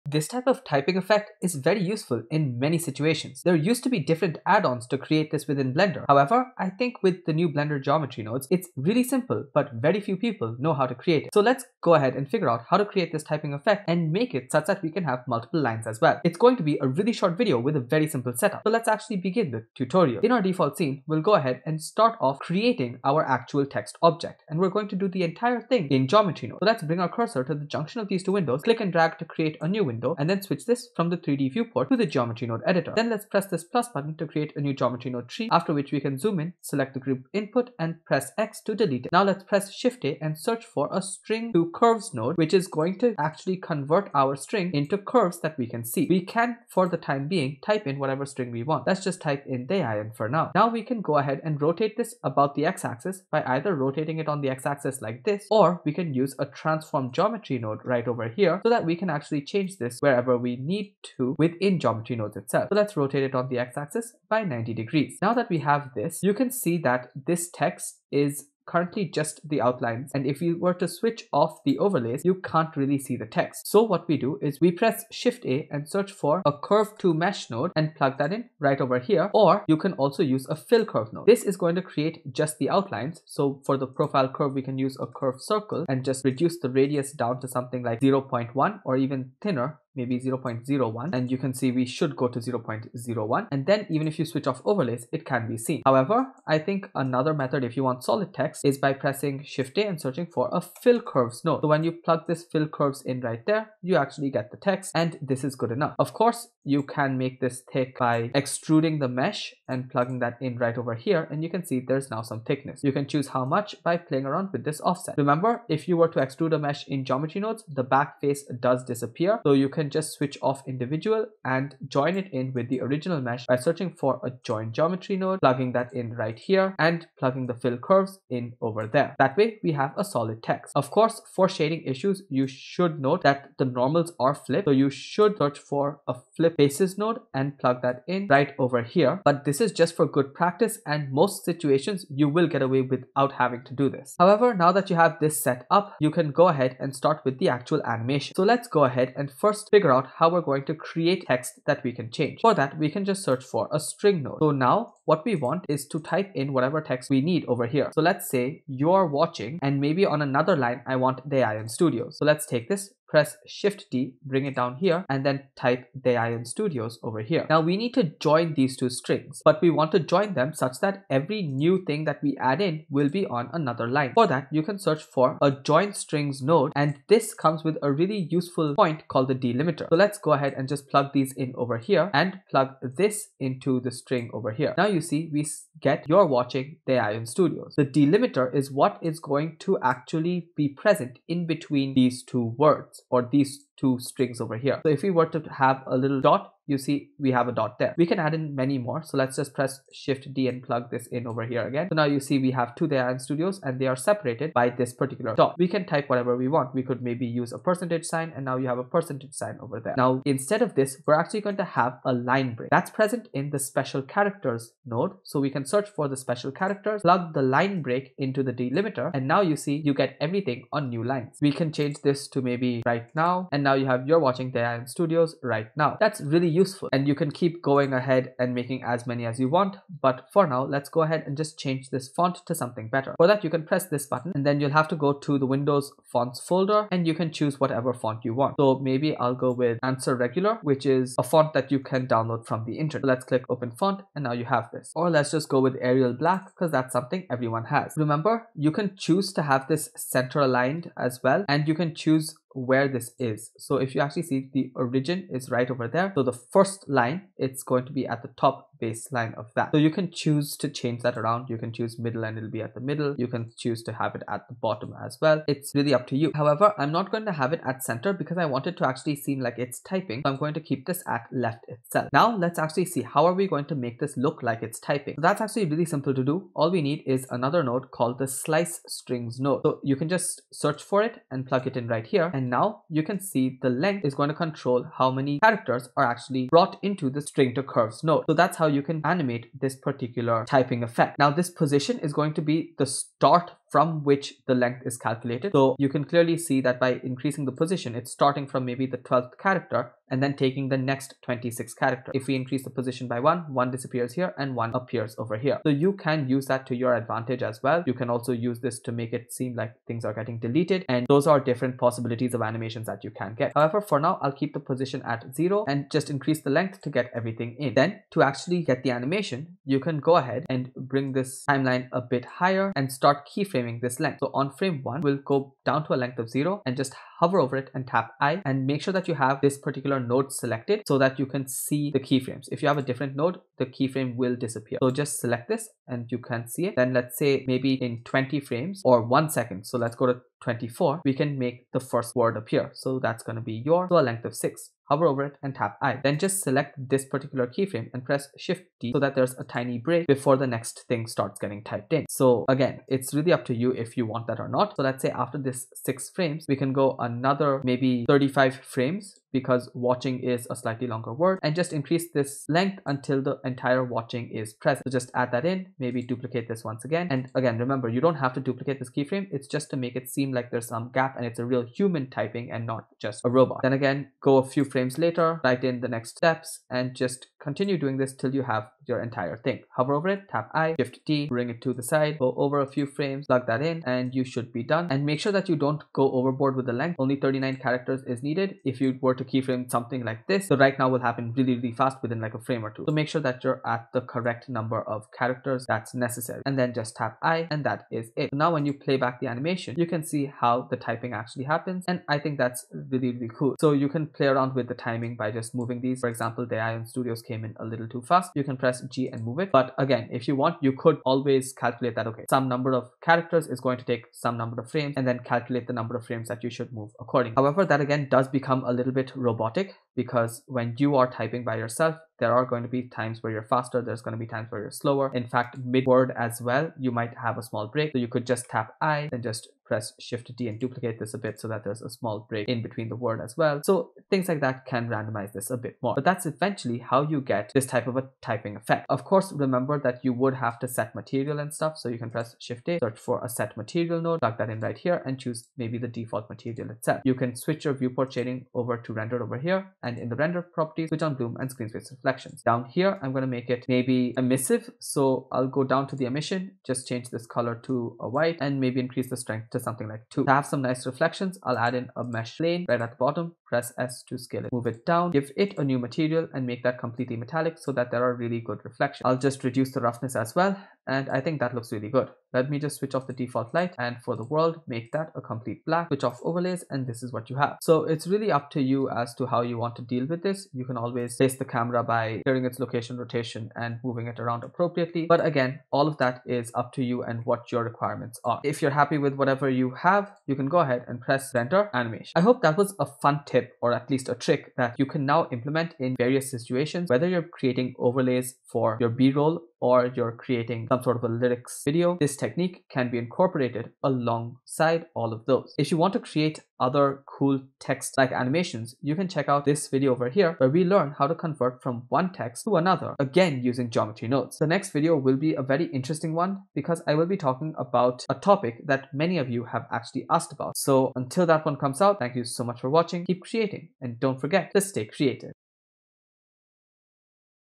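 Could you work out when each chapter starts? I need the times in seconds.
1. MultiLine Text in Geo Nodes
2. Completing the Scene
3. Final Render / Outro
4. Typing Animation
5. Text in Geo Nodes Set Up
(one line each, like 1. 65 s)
1. 145 s
2. 438 s
3. 492 s
4. 272 s
5. 20 s.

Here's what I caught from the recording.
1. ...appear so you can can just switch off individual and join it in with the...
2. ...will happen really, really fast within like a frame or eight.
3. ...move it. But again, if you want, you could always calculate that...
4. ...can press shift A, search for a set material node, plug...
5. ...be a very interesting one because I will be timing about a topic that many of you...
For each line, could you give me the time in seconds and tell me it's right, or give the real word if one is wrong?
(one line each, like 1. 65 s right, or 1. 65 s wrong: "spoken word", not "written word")
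1. 118 s wrong: "disappear", not "appear"
2. 390 s wrong: "two", not "eight"
3. 409 s right
4. 441 s right
5. 515 s wrong: "talking", not "timing".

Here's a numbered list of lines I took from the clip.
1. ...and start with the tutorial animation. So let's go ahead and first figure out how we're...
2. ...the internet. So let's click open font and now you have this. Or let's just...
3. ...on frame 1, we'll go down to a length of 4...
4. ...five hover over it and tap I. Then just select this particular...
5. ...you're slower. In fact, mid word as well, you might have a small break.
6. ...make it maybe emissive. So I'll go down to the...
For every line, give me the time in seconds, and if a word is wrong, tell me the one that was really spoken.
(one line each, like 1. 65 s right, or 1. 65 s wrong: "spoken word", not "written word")
1. 146 s wrong: "actual", not "tutorial"
2. 242 s right
3. 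324 s wrong: "0", not "4"
4. 344 s wrong: "six", not "five"
5. 424 s right
6. 453 s right.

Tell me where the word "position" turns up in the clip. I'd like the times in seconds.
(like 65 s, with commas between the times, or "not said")
291 s, 297 s, 302 s, 314 s.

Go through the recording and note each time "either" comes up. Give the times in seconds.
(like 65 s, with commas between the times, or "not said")
53 s.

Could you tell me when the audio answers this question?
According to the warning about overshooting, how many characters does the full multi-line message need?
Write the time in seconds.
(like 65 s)
387 s.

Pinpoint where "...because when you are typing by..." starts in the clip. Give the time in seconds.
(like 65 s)
419 s.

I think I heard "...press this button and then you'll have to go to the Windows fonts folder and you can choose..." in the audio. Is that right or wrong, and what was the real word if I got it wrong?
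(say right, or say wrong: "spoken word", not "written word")
right.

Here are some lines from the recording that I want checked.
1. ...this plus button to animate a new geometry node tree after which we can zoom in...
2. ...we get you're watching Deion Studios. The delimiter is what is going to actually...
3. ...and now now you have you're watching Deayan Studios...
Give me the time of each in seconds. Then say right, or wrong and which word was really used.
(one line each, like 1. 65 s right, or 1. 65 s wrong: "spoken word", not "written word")
1. 33 s wrong: "create", not "animate"
2. 185 s right
3. 223 s right.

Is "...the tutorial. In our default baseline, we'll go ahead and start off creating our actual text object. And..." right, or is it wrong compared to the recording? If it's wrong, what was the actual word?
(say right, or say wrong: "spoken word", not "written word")
wrong: "scene", not "baseline".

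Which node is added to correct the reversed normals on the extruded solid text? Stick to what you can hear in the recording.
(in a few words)
flip faces.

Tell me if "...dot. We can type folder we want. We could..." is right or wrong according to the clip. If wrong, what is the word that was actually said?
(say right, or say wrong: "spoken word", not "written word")
wrong: "whatever", not "folder".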